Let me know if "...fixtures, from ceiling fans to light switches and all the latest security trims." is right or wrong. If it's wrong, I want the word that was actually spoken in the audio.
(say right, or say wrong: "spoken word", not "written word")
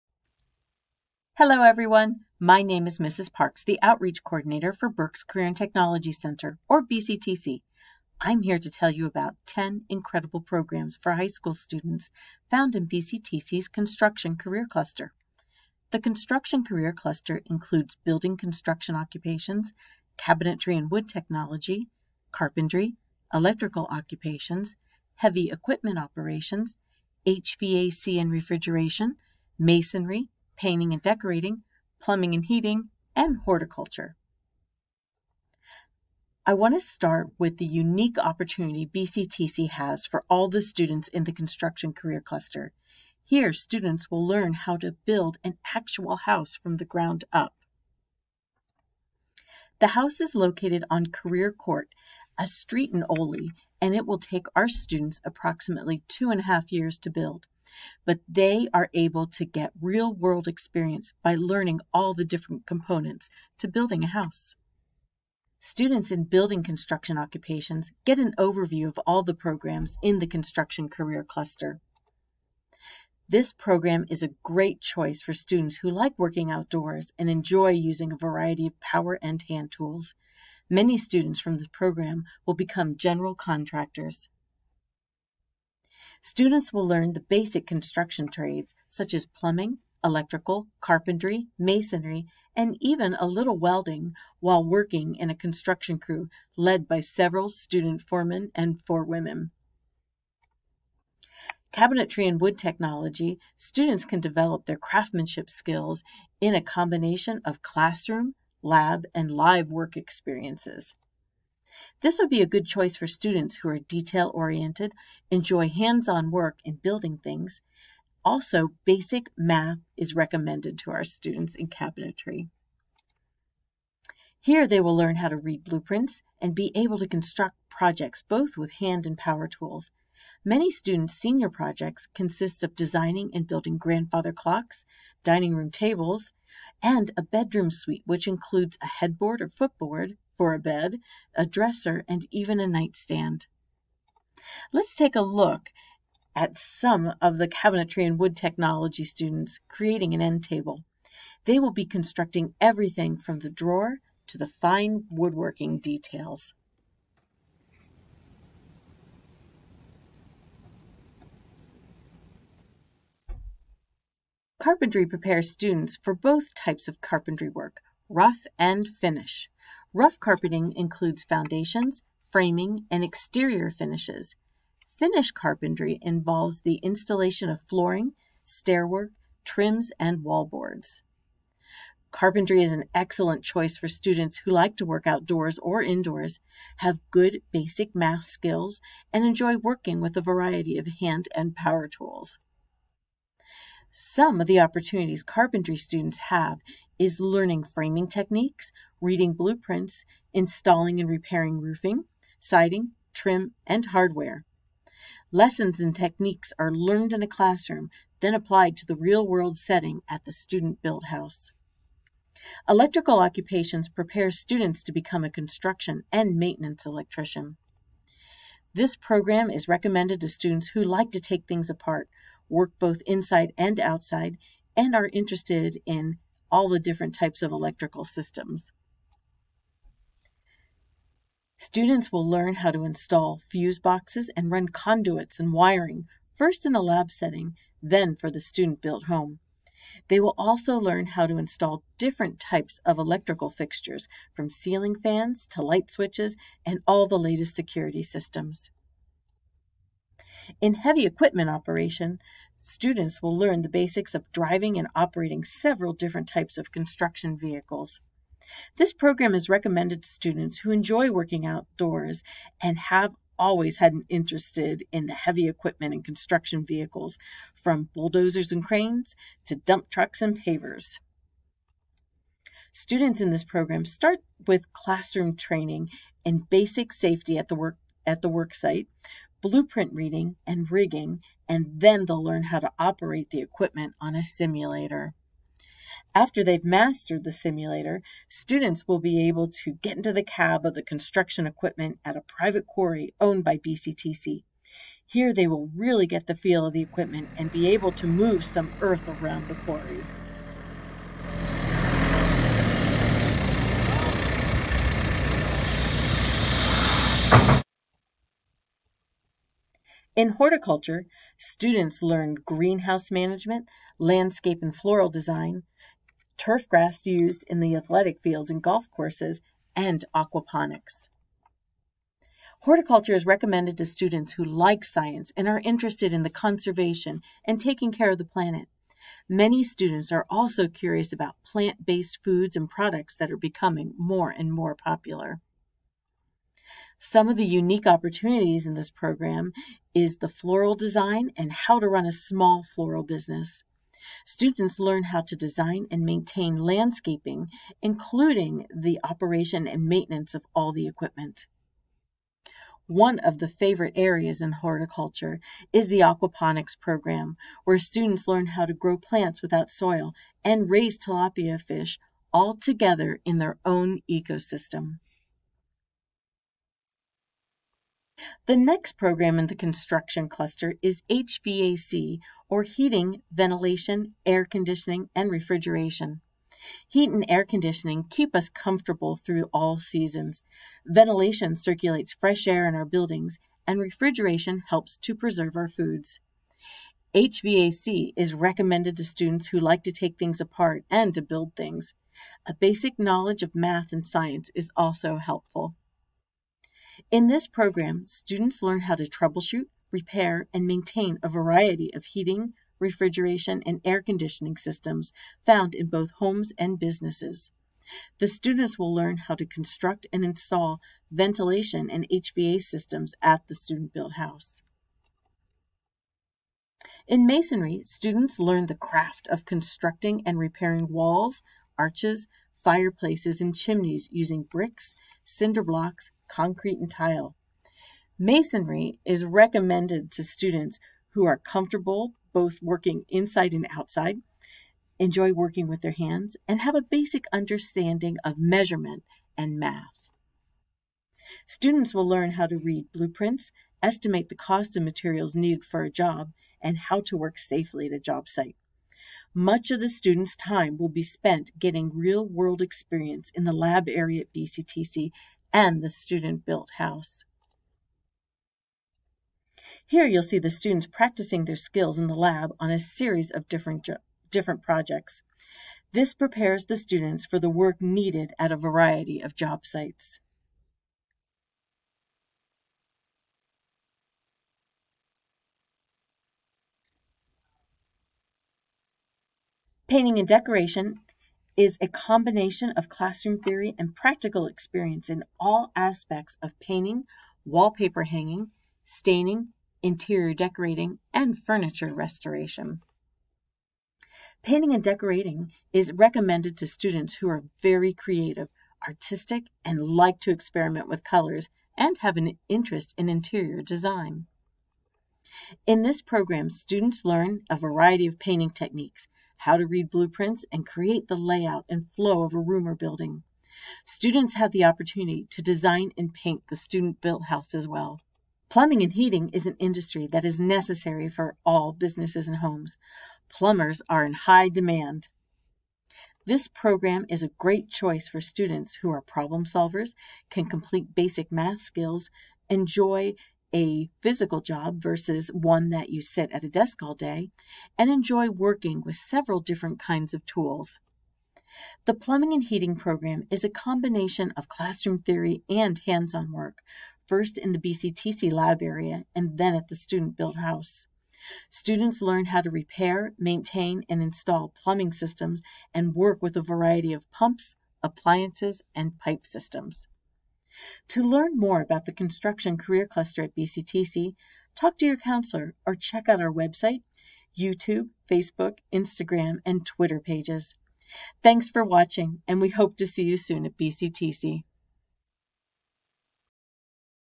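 wrong: "systems", not "trims".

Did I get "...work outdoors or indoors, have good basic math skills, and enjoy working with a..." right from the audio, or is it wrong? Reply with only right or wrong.
right.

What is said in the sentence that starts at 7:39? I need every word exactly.
Here you'll see the students practicing their skills in the lab on a series of different, different projects.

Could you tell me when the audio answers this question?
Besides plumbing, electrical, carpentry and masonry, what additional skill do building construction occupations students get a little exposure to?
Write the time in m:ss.
1:33.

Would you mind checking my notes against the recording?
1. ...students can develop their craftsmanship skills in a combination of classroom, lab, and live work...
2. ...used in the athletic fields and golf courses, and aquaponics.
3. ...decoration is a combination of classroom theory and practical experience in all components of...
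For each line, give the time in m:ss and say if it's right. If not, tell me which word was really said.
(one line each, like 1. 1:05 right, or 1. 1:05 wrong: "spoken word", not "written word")
1. 1:43 right
2. 5:17 right
3. 8:00 wrong: "aspects", not "components".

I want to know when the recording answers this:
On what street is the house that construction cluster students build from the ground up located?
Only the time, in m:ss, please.
0:51.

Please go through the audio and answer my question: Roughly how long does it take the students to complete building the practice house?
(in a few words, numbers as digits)
2.5 years.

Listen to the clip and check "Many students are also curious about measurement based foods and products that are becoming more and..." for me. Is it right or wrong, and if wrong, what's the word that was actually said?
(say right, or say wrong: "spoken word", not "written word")
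wrong: "plant", not "measurement".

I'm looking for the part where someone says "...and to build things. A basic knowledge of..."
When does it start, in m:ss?
6:30.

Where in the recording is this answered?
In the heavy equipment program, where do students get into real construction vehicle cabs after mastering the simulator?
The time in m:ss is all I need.
4:52.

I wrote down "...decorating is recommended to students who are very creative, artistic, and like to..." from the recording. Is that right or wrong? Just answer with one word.
right.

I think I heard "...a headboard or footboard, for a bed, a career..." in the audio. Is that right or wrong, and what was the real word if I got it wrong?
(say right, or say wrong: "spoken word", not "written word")
wrong: "dresser", not "career".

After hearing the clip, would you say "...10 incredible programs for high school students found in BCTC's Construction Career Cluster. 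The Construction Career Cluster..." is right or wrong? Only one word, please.
right.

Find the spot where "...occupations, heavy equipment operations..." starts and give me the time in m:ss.
0:23.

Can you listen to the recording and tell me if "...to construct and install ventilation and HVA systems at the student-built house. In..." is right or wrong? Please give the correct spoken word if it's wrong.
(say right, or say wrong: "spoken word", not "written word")
right.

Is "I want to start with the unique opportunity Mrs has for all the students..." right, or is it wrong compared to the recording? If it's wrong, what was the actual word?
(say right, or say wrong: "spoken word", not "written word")
wrong: "BCTC", not "Mrs".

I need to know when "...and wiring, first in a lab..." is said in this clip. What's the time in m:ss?
3:55.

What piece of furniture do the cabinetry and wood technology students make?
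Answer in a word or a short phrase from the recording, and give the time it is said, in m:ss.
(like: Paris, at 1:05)
end table, at 2:30.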